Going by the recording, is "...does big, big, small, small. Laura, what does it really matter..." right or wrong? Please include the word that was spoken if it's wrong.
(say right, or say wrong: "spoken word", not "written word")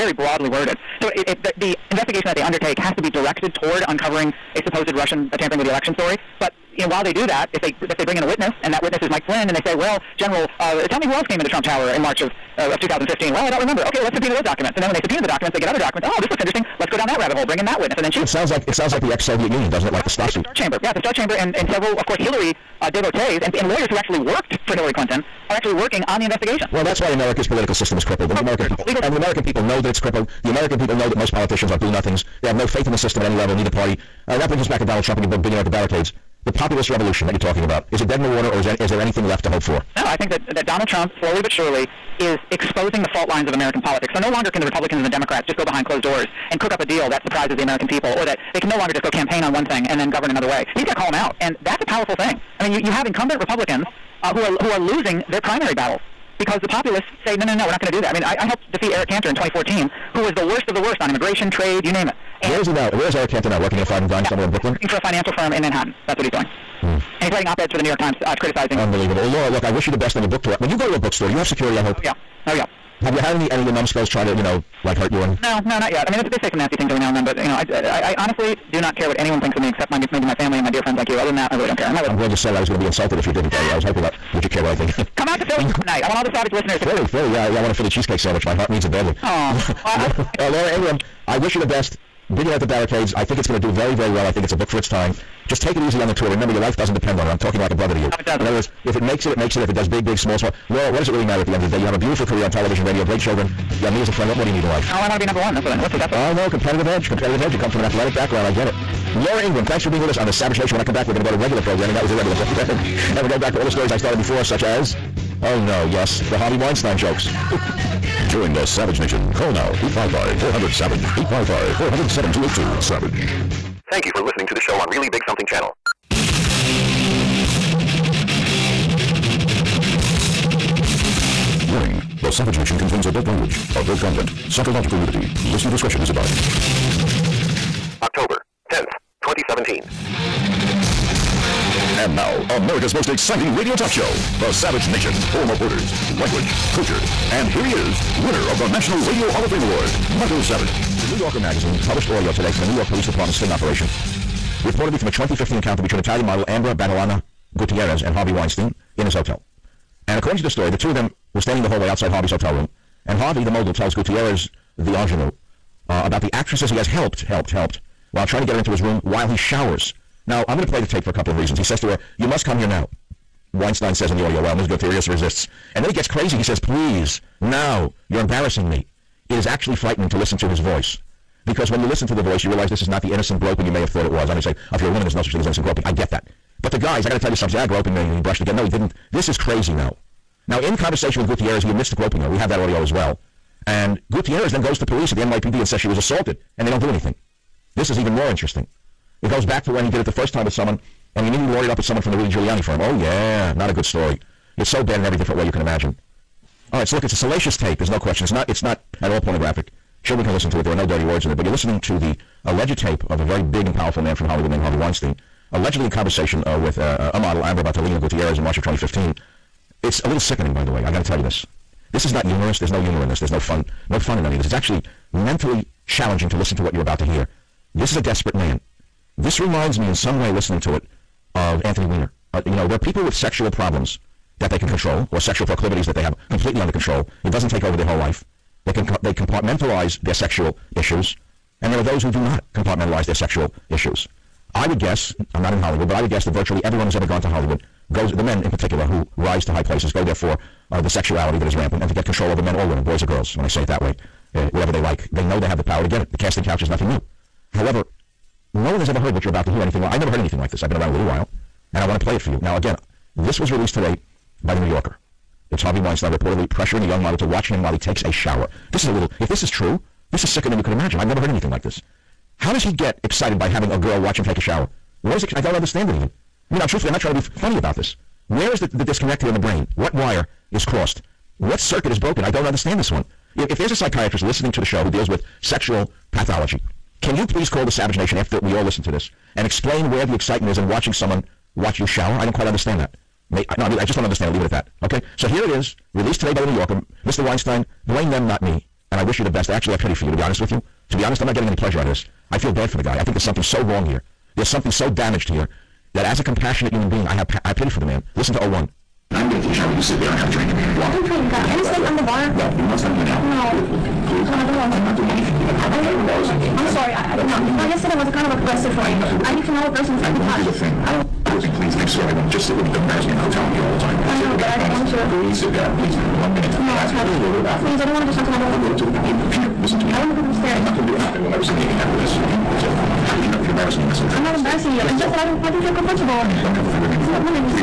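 right.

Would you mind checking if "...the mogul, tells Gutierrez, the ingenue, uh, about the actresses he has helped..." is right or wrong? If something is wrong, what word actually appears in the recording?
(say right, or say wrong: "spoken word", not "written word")
right.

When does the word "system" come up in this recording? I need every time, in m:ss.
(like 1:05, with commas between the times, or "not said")
0:27, 0:32.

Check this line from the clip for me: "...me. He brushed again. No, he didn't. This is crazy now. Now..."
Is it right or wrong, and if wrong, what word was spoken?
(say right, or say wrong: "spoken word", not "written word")
right.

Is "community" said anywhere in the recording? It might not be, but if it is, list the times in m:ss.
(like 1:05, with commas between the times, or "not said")
not said.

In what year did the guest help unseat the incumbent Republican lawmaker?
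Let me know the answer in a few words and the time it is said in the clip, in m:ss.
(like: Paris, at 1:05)
2014, at 0:59.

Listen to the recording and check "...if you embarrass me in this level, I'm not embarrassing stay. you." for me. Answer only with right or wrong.
wrong.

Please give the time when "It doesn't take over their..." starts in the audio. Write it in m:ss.
3:57.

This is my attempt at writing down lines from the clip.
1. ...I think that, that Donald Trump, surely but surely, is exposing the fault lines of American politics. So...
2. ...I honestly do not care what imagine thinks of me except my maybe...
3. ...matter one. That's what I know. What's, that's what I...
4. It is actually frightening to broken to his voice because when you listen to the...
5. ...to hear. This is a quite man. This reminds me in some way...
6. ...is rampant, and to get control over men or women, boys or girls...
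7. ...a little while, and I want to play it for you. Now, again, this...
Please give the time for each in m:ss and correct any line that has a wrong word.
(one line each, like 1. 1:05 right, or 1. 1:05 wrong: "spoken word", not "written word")
1. 0:40 wrong: "slowly", not "surely"
2. 1:17 wrong: "anyone", not "imagine"
3. 1:45 wrong: "number", not "matter"
4. 2:59 wrong: "listen", not "broken"
5. 3:46 wrong: "desperate", not "quite"
6. 4:11 right
7. 4:20 right.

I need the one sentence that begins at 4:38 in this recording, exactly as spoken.
Where is the, the disconnect here in the brain?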